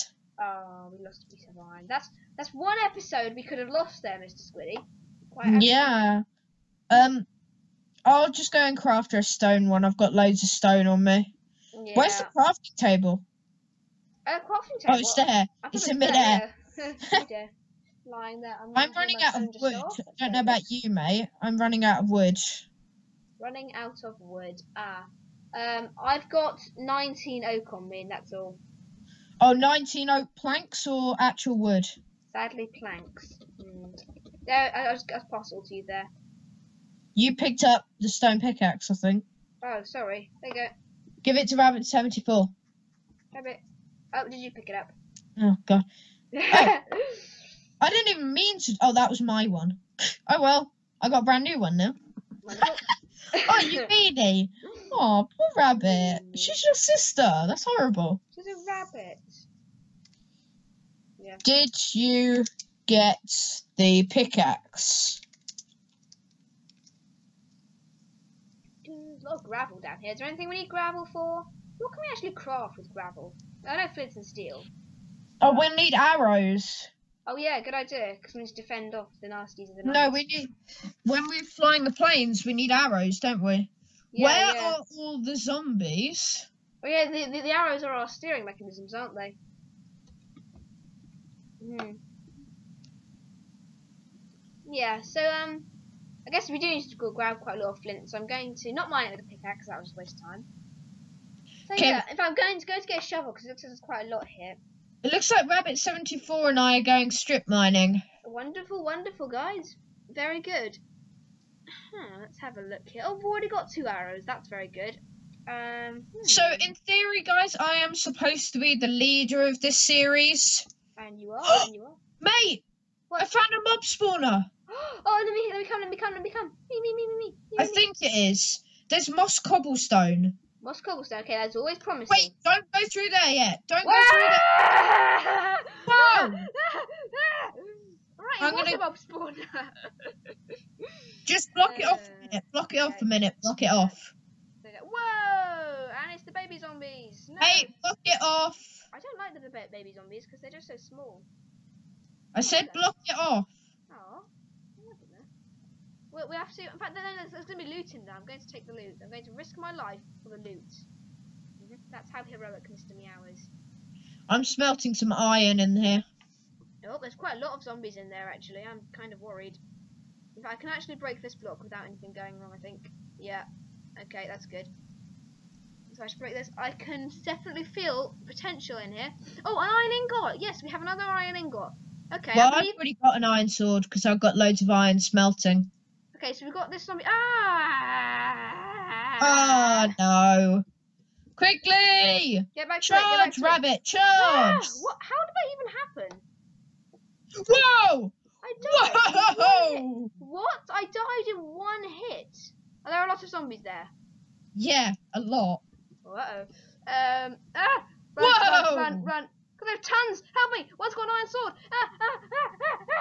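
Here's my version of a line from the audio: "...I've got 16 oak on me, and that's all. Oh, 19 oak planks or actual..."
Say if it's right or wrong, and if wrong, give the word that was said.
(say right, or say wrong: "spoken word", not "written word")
wrong: "19", not "16".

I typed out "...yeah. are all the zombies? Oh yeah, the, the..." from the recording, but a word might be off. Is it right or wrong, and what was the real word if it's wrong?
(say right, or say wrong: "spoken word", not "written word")
right.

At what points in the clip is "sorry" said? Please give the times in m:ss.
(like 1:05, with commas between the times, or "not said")
0:39.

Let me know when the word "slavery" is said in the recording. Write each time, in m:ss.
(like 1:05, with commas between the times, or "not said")
not said.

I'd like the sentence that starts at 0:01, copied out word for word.
That's that's one episode we could have lost there, Mr.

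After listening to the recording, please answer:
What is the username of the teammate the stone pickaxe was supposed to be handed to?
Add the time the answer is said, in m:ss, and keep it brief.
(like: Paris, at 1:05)
Rabbit74, at 0:41.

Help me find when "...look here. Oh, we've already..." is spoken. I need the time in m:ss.
1:52.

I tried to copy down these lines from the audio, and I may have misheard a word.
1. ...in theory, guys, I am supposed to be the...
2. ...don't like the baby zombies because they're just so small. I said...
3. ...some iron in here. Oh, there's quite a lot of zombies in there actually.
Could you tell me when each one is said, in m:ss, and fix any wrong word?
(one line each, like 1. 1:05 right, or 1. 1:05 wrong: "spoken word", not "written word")
1. 1:56 right
2. 2:28 right
3. 2:44 right.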